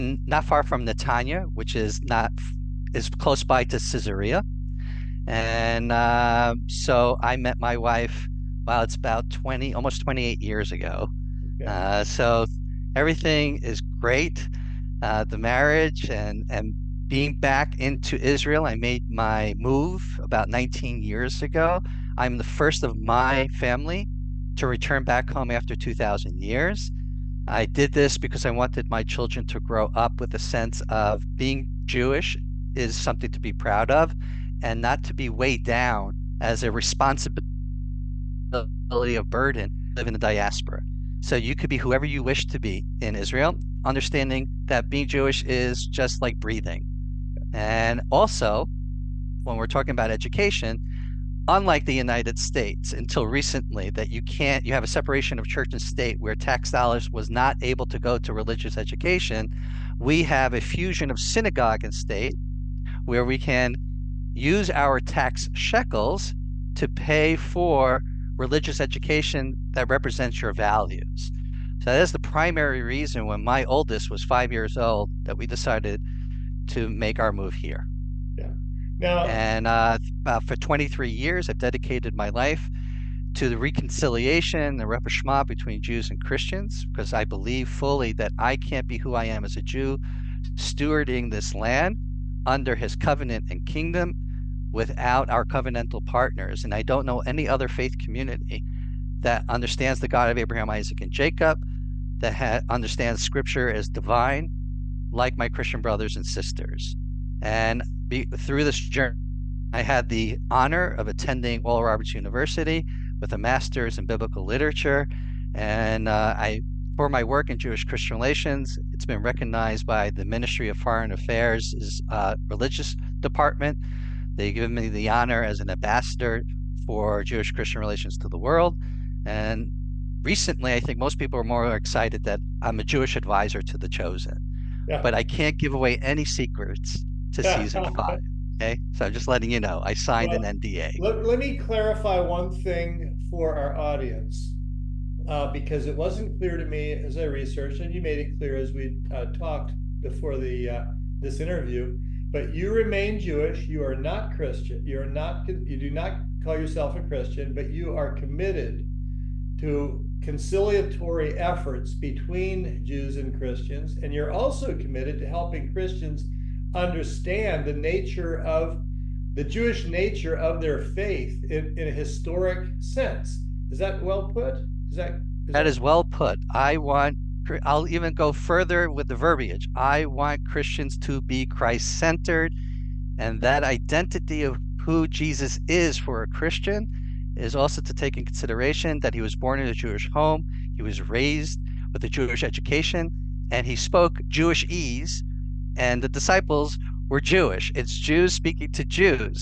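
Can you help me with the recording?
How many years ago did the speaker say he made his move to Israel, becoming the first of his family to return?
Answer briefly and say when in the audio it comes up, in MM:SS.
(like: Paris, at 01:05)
19, at 00:20.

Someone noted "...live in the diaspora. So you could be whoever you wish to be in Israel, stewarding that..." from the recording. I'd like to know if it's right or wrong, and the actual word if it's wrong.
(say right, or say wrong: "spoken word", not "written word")
wrong: "understanding", not "stewarding".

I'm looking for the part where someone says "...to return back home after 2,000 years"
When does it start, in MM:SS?
00:24.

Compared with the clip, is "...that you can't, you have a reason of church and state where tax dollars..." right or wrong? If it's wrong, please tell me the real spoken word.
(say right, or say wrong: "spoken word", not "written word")
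wrong: "separation", not "reason".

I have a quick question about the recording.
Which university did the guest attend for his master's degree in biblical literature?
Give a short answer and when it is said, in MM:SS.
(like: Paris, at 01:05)
Oral Roberts University, at 01:51.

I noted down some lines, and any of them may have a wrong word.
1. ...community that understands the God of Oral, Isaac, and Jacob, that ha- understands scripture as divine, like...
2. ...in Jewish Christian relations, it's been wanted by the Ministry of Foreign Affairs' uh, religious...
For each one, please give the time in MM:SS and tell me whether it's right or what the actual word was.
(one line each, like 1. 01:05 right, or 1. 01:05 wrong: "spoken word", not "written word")
1. 01:37 wrong: "Abraham", not "Oral"
2. 01:57 wrong: "recognized", not "wanted".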